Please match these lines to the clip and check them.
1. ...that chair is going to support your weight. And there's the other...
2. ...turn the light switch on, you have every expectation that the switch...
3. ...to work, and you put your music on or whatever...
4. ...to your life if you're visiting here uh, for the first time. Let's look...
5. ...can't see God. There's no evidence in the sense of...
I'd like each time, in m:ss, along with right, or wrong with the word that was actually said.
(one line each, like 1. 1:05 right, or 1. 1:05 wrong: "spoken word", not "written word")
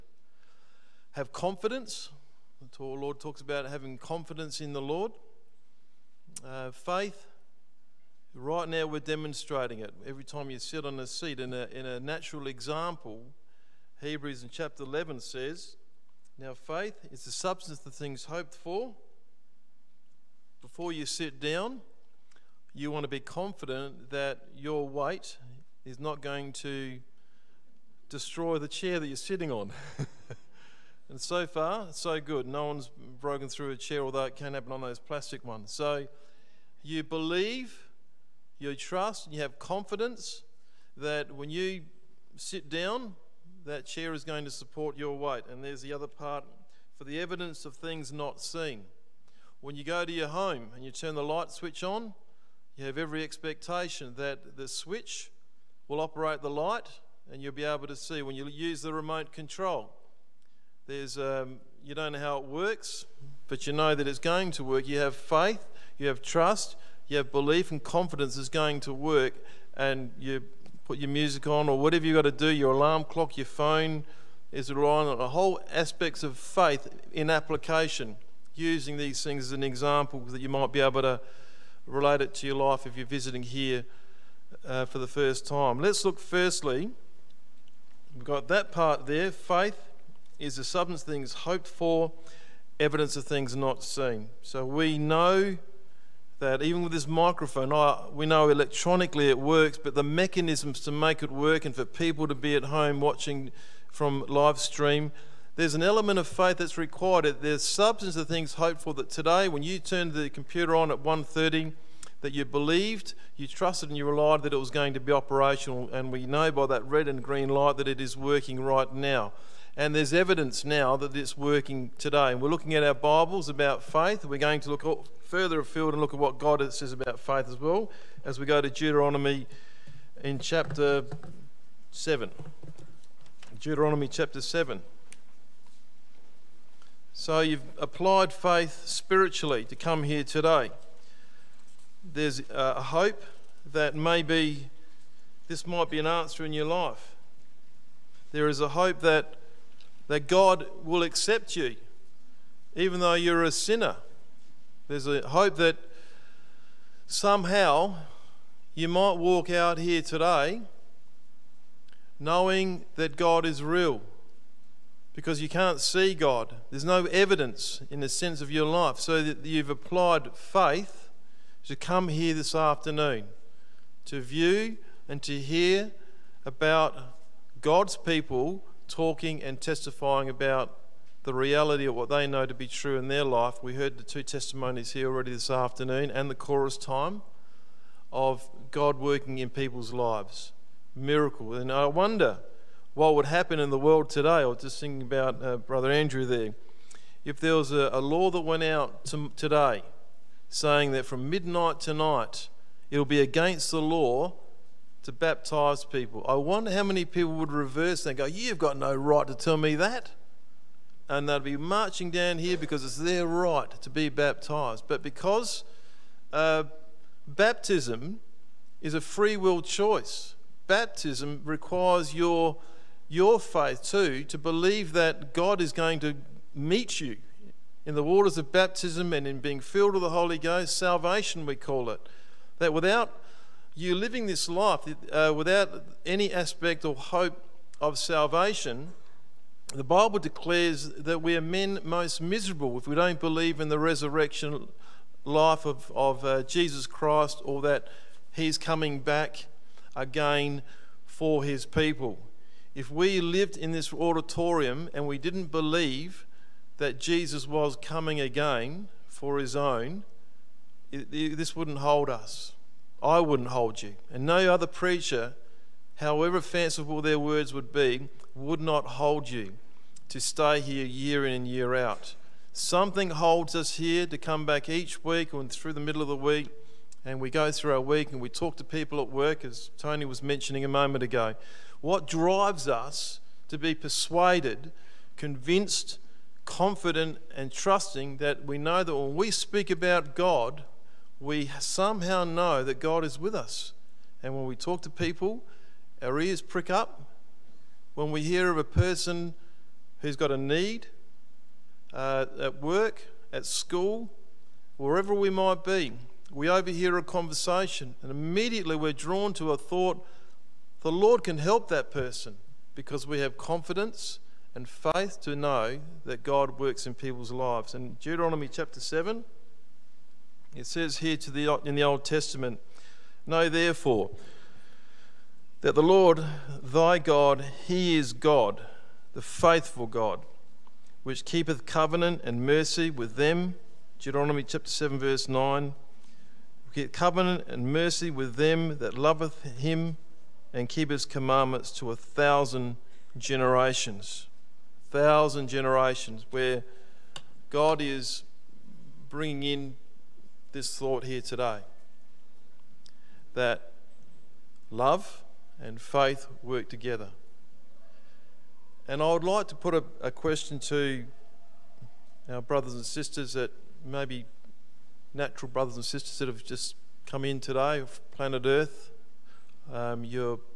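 1. 0:43 right
2. 0:50 right
3. 1:08 right
4. 1:22 right
5. 2:45 right.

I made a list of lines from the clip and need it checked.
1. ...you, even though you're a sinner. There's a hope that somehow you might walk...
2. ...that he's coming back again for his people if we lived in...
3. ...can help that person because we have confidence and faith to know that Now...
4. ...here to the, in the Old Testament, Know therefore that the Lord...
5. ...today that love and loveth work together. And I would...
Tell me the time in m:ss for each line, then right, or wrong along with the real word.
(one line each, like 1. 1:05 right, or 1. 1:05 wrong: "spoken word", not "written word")
1. 2:31 right
2. 4:07 right
3. 5:11 wrong: "God", not "Now"
4. 5:20 right
5. 5:51 wrong: "faith", not "loveth".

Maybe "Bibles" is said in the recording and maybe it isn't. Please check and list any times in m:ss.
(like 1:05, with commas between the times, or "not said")
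2:02, 3:59.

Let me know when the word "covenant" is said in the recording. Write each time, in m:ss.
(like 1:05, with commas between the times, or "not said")
5:31, 5:36.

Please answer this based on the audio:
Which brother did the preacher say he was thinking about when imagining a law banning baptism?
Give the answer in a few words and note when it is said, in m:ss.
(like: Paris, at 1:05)
Brother Andrew, at 3:15.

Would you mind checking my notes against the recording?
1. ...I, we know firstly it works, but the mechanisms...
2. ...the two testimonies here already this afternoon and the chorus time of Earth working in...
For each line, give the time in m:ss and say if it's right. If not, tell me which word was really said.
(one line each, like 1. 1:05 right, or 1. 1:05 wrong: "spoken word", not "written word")
1. 1:37 wrong: "electronically", not "firstly"
2. 3:03 wrong: "God", not "Earth".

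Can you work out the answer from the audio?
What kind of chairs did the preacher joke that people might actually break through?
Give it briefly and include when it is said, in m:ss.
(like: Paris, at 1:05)
plastic ones, at 0:34.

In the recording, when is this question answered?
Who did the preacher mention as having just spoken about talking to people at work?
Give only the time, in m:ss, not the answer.
4:39.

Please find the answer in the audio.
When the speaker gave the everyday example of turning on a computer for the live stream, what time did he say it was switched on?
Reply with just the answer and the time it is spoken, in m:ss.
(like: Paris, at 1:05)
1:30, at 1:51.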